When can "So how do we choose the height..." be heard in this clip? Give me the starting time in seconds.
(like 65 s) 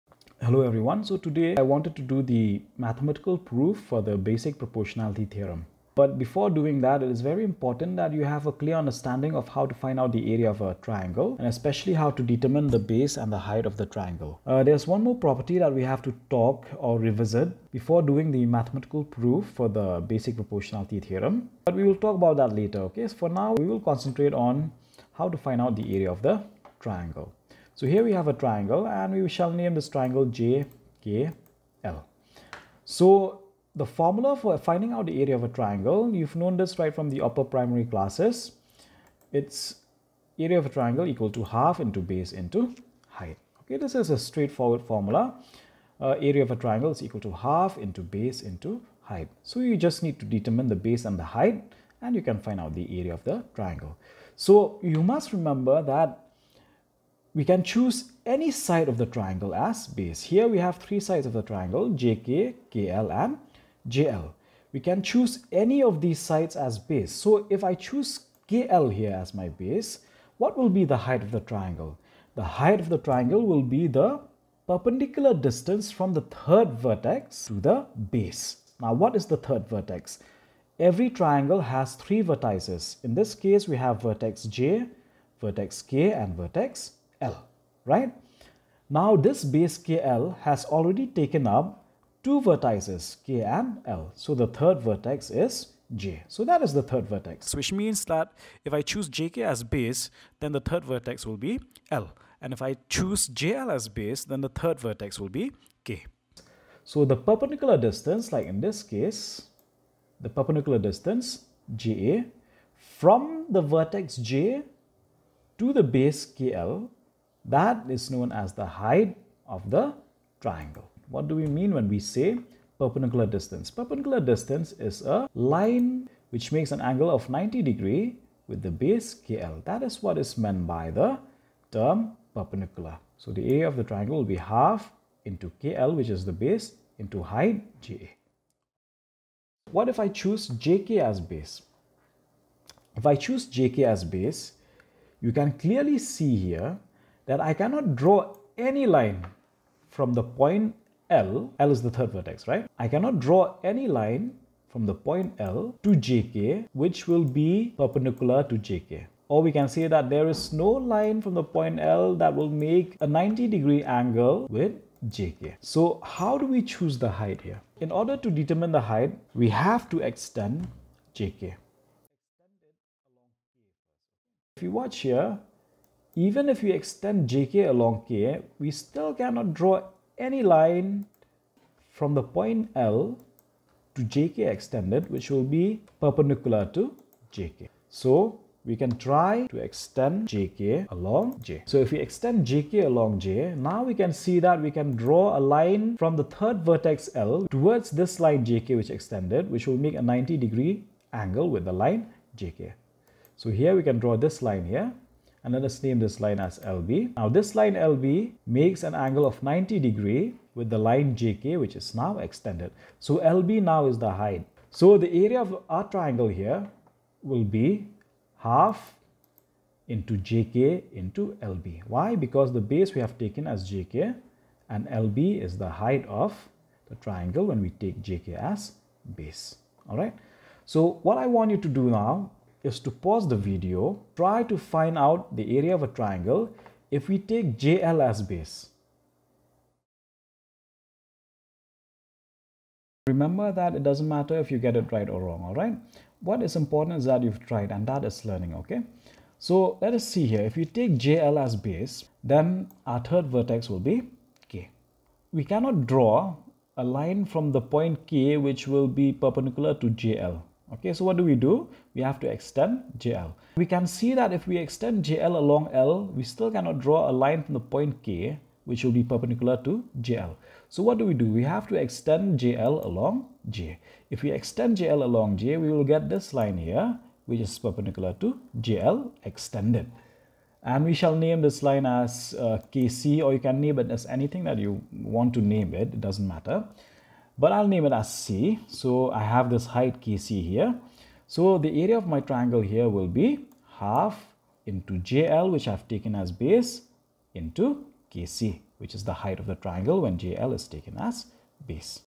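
165 s.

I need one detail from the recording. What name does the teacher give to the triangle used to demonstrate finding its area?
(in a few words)
JKL.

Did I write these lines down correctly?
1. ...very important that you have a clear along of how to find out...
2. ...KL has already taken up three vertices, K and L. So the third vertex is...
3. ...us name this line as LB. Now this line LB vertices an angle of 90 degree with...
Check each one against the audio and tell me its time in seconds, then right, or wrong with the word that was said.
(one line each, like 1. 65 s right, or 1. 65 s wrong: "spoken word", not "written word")
1. 7 s wrong: "understanding", not "along"
2. 89 s wrong: "two", not "three"
3. 205 s wrong: "makes", not "vertices".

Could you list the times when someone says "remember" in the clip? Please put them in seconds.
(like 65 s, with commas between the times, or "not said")
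55 s, 243 s.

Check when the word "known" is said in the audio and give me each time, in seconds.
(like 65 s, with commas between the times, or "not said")
36 s, 118 s.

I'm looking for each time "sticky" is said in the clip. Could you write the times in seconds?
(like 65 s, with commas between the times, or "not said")
not said.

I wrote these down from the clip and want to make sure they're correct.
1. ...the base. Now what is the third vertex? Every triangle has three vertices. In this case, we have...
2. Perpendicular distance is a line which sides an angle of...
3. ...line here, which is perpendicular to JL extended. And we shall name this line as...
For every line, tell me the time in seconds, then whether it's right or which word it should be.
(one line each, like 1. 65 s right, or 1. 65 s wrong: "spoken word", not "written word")
1. 77 s right
2. 123 s wrong: "makes", not "sides"
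3. 276 s right.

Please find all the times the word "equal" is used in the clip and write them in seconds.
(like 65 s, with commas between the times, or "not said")
41 s, 47 s.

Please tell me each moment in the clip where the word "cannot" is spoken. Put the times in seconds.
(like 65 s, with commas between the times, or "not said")
147 s, 152 s, 179 s, 255 s, 266 s.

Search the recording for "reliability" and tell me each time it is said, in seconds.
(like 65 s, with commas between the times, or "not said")
not said.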